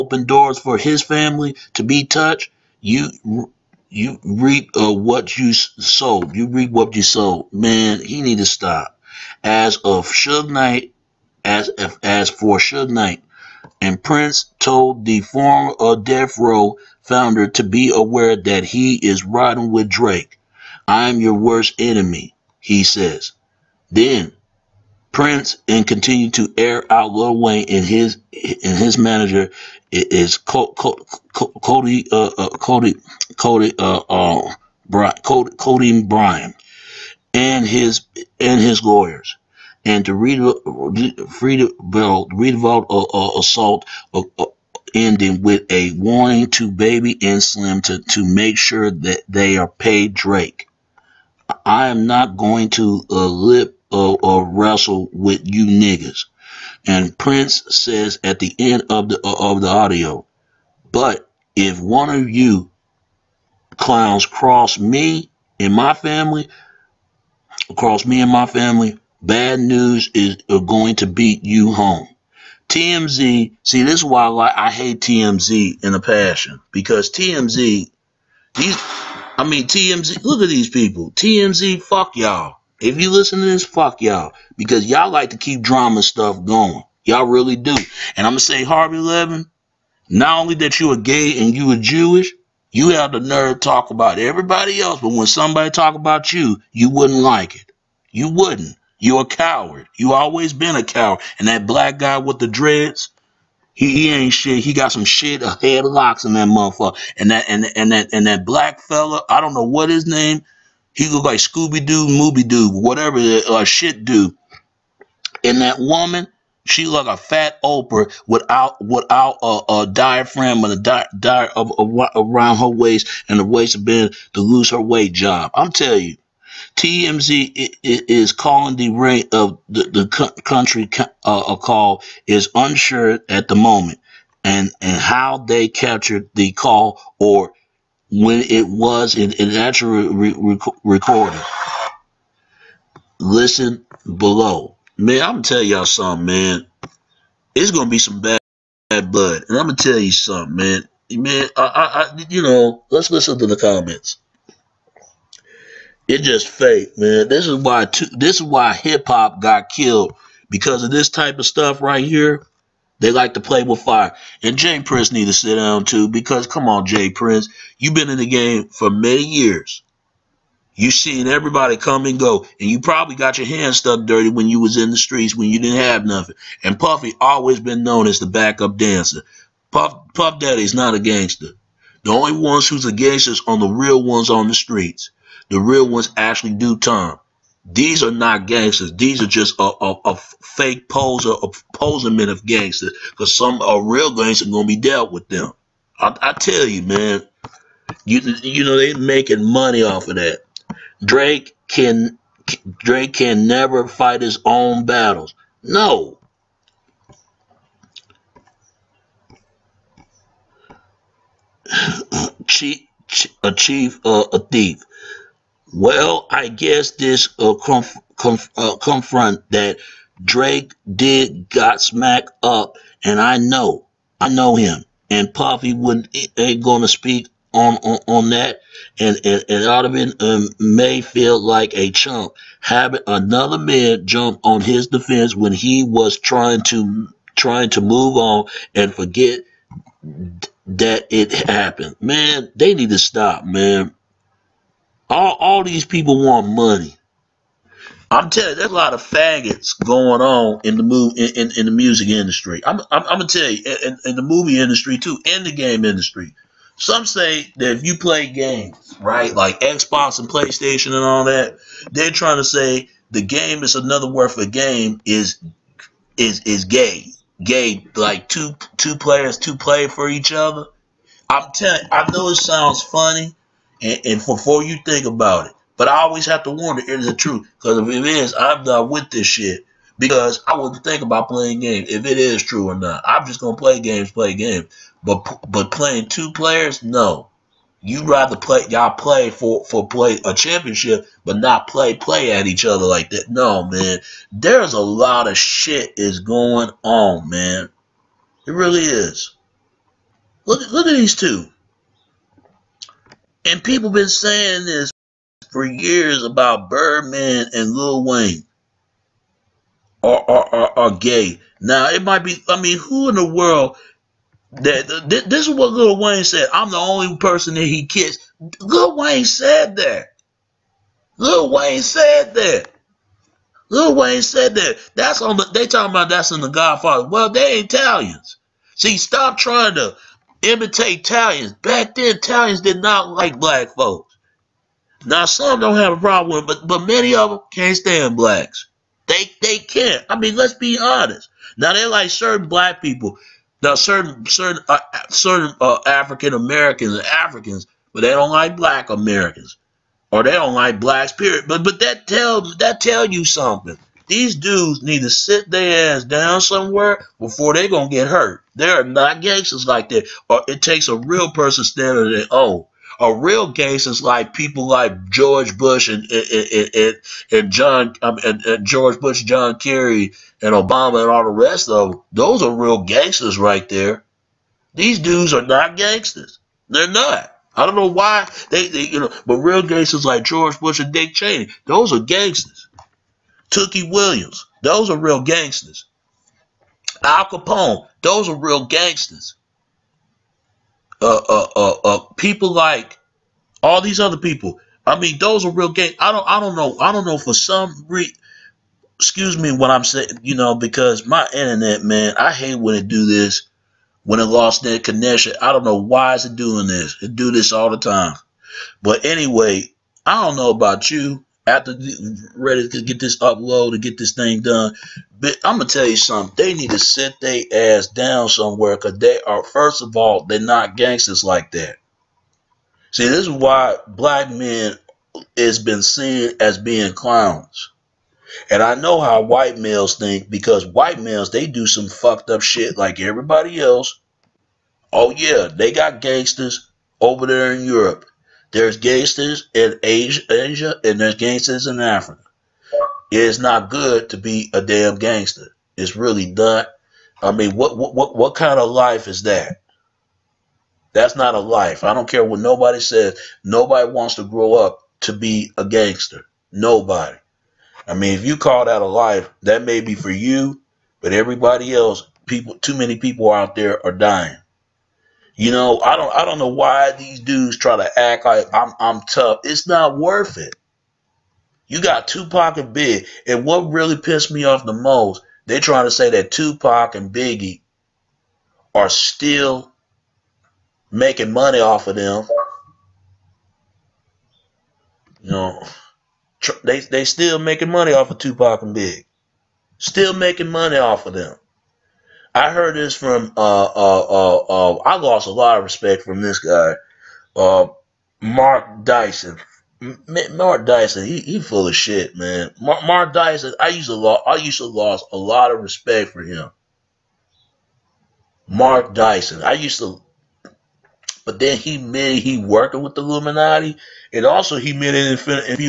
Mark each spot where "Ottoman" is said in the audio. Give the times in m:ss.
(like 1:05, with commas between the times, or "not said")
3:49.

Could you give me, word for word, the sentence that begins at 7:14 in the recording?
Oh yeah, they got gangsters over there in Europe.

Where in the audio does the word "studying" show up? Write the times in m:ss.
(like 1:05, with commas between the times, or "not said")
not said.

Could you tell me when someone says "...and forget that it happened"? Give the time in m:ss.
3:58.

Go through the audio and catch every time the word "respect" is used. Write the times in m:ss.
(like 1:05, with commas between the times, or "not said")
8:15, 8:25.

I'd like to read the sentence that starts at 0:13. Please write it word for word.
And Prince told the former Death Row founder to be aware that he is riding with Drake.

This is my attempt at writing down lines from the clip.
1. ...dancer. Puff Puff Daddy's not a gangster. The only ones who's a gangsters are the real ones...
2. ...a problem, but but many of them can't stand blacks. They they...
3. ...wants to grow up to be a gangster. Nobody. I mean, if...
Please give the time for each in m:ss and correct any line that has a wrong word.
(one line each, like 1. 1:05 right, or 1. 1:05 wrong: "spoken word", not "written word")
1. 2:58 right
2. 5:35 right
3. 7:33 right.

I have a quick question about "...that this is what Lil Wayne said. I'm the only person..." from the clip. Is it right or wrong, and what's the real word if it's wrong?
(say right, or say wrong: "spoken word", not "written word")
right.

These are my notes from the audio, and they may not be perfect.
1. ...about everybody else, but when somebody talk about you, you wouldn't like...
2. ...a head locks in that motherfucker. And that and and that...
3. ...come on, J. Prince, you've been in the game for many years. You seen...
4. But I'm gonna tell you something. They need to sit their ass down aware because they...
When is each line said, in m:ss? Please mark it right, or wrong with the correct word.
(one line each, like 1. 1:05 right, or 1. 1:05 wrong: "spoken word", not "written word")
1. 1:33 right
2. 1:45 right
3. 2:46 right
4. 6:55 wrong: "somewhere", not "aware".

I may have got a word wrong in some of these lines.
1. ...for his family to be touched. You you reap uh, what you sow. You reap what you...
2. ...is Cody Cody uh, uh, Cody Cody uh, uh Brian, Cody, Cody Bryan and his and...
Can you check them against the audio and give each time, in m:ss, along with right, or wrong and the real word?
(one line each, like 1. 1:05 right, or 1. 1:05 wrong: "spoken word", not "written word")
1. 0:00 right
2. 0:29 right.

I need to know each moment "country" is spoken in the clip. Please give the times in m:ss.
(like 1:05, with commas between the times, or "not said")
2:10.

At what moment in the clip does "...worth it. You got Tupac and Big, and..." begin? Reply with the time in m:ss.
7:49.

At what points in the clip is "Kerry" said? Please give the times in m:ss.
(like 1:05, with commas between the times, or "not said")
6:09.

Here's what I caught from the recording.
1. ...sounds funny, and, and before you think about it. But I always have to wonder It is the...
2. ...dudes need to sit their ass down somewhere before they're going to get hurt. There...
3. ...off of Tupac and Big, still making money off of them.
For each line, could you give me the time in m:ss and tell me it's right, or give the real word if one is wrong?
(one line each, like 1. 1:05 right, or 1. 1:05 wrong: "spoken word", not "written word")
1. 4:32 right
2. 5:54 right
3. 8:07 right.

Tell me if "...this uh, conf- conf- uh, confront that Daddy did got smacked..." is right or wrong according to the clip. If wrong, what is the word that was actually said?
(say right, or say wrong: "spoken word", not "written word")
wrong: "Drake", not "Daddy".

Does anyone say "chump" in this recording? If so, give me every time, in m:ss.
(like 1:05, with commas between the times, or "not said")
3:51.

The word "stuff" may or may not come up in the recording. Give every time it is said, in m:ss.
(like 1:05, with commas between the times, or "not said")
1:26, 2:41.